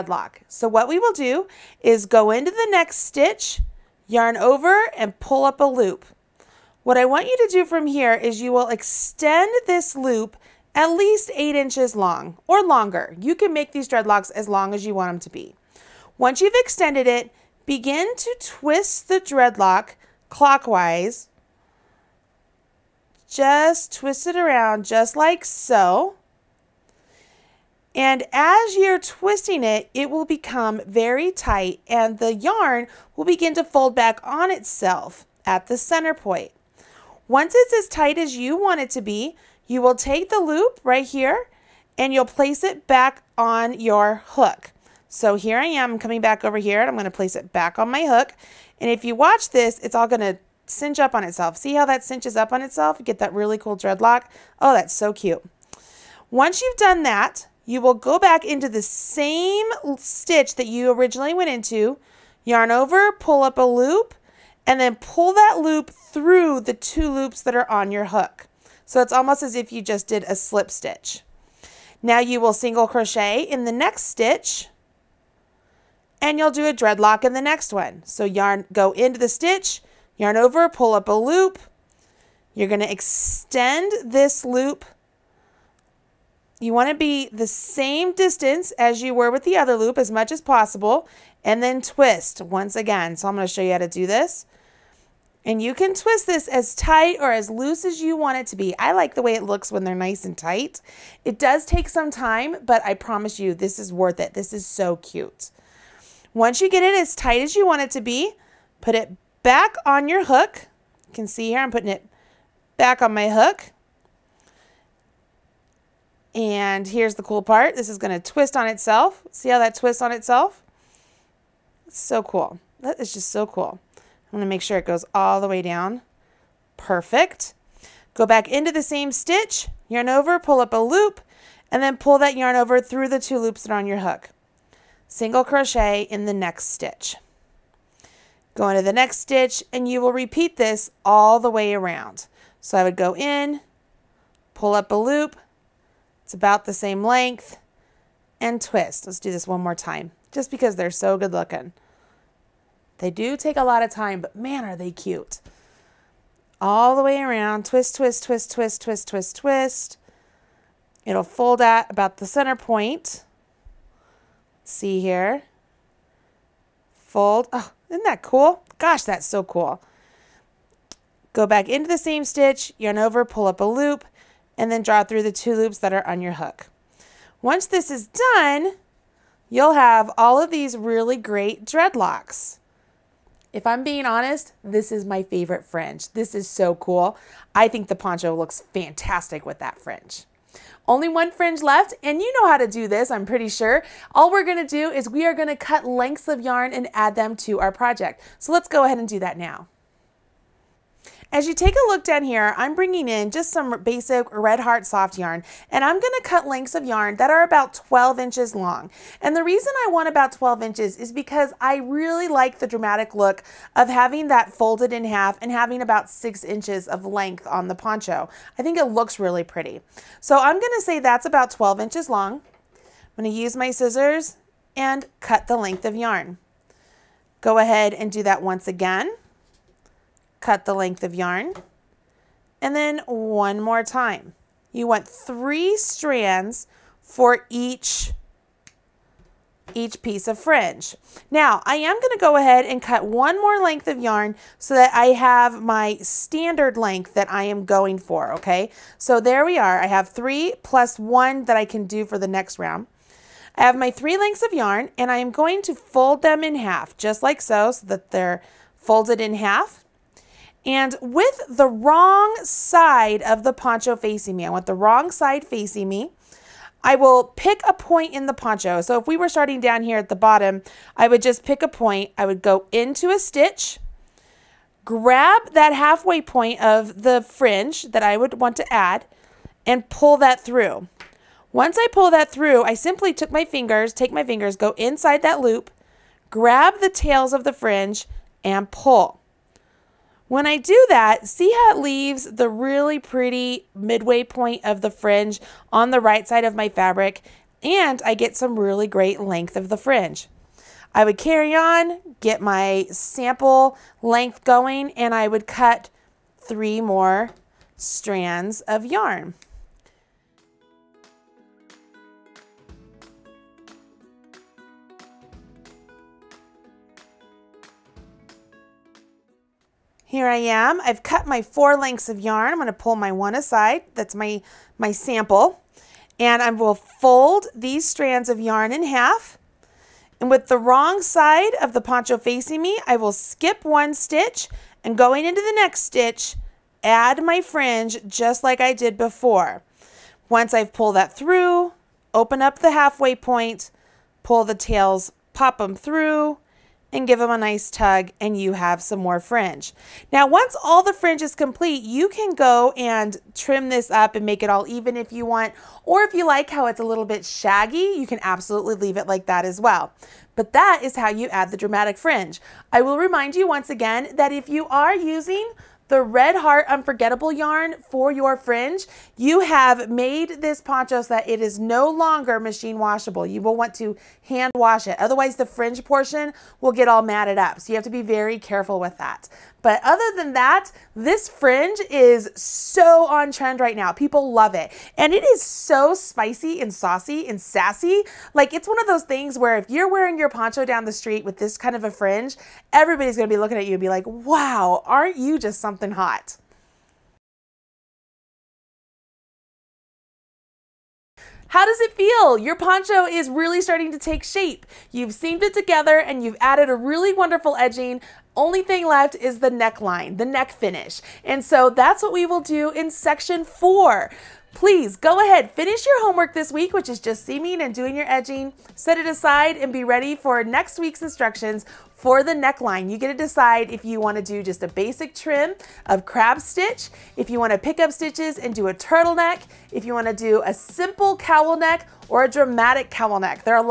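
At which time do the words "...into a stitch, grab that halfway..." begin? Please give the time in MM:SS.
04:32.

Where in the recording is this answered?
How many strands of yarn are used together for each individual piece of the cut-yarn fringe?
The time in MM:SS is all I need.
03:55.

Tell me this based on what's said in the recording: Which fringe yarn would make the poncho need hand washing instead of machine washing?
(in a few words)
Red Heart Unforgettable.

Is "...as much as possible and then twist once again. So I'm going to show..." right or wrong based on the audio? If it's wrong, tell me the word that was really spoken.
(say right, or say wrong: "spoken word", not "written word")
right.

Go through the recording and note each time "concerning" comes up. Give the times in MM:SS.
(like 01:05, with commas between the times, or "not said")
not said.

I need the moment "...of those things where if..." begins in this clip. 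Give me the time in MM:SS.
06:28.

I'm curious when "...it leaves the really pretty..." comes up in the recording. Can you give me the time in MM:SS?
04:51.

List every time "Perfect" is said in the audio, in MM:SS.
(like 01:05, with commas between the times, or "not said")
02:06.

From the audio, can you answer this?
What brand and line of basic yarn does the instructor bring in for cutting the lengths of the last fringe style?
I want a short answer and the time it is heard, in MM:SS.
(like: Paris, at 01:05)
Red Heart Soft, at 03:24.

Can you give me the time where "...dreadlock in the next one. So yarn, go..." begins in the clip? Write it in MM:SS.
01:16.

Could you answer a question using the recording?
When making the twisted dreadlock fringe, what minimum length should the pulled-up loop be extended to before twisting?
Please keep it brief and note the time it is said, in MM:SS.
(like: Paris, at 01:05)
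8 inches, at 00:11.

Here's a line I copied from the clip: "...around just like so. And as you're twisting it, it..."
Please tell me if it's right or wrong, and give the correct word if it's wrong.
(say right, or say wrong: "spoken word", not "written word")
right.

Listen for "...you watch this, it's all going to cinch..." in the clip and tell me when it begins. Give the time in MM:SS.
00:49.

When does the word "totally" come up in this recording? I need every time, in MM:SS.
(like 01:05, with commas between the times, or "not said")
not said.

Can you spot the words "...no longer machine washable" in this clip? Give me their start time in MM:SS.
06:11.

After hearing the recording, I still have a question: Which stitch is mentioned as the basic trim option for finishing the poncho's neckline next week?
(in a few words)
Crab stitch.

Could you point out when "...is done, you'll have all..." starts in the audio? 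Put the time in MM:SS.
02:57.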